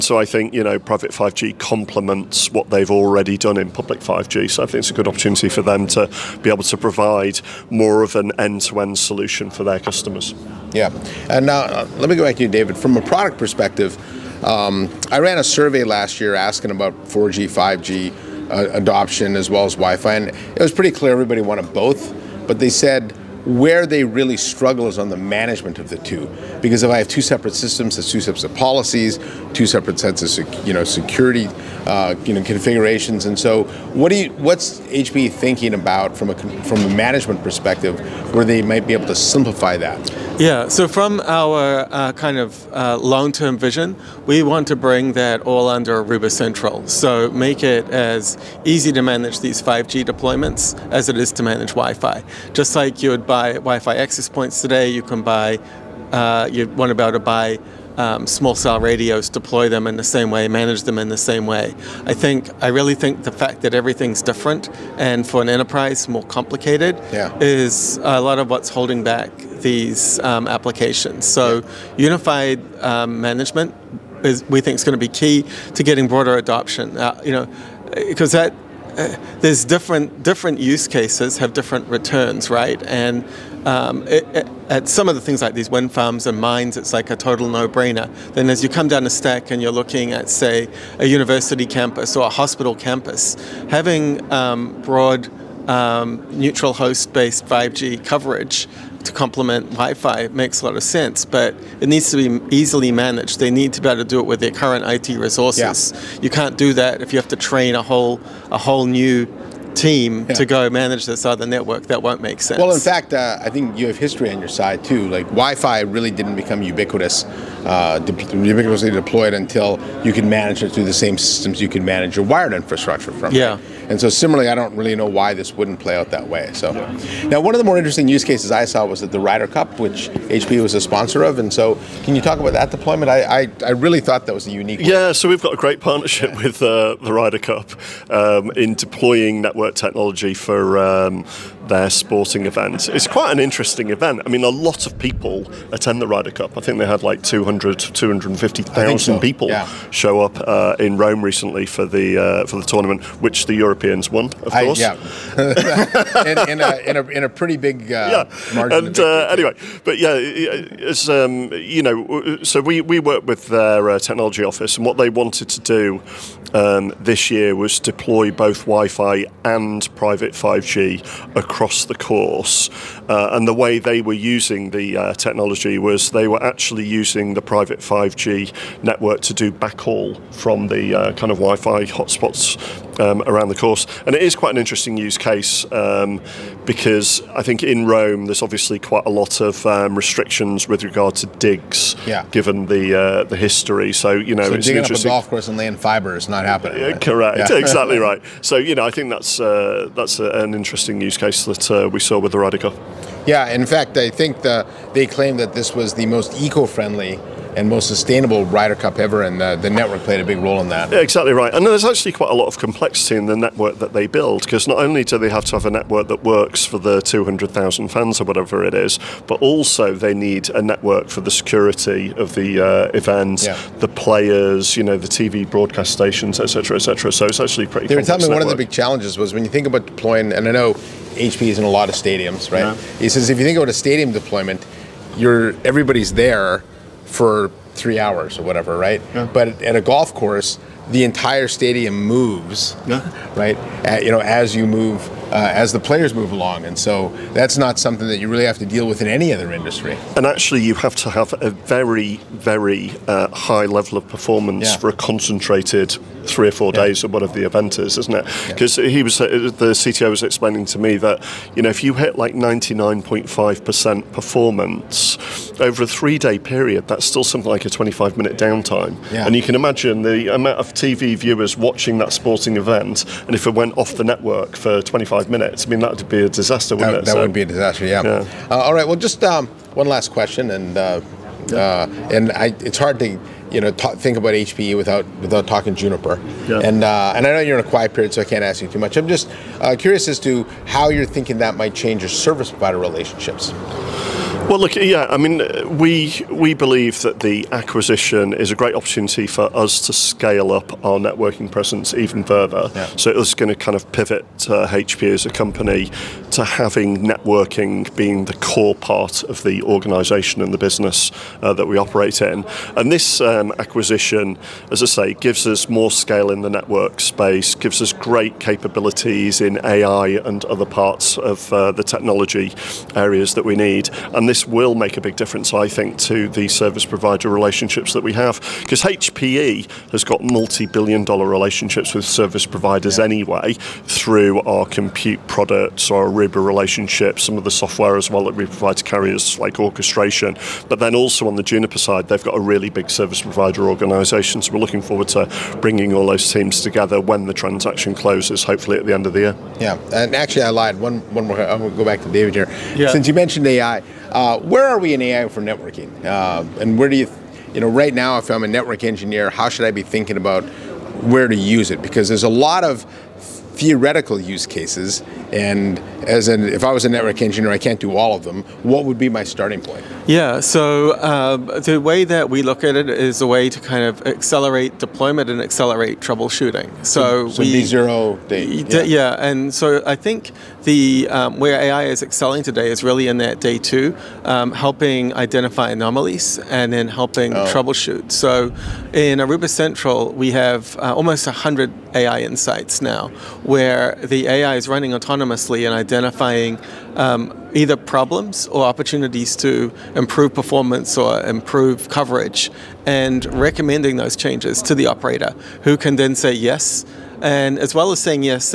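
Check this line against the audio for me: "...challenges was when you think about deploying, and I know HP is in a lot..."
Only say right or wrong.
right.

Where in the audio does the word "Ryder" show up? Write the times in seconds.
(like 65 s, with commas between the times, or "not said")
129 s, 137 s, 146 s, 202 s, 208 s.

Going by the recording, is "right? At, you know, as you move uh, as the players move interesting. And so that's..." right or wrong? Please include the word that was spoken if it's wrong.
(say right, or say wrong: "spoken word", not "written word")
wrong: "along", not "interesting".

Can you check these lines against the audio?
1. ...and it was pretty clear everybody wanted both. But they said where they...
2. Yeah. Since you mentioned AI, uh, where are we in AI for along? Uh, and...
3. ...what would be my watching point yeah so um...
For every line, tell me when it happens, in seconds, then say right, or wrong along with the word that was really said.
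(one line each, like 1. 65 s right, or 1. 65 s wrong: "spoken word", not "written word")
1. 20 s right
2. 352 s wrong: "networking", not "along"
3. 368 s wrong: "starting", not "watching".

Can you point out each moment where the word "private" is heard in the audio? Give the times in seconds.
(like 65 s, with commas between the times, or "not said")
0 s, 169 s, 177 s.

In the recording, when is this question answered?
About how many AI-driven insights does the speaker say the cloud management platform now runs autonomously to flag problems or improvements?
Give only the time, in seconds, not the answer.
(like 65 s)
390 s.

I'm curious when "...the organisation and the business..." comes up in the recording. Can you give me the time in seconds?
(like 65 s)
309 s.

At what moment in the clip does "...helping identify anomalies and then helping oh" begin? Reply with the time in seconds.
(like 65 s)
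384 s.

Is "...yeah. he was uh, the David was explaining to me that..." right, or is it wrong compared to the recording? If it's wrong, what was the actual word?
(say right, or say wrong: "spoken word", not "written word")
wrong: "CTO", not "David".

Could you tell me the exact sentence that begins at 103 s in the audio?
They need to be able to do it with their current IT resources.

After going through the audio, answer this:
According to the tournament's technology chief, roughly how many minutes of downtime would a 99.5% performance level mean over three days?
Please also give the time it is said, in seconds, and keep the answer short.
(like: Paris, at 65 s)
25 minutes, at 267 s.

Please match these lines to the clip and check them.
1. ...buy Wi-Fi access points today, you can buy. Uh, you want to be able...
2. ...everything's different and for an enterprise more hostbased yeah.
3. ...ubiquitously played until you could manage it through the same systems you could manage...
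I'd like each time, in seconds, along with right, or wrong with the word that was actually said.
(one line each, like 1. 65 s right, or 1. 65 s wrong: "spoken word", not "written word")
1. 53 s right
2. 63 s wrong: "complicated", not "hostbased"
3. 118 s wrong: "deployed", not "played".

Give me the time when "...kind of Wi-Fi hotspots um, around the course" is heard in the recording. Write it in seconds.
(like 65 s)
181 s.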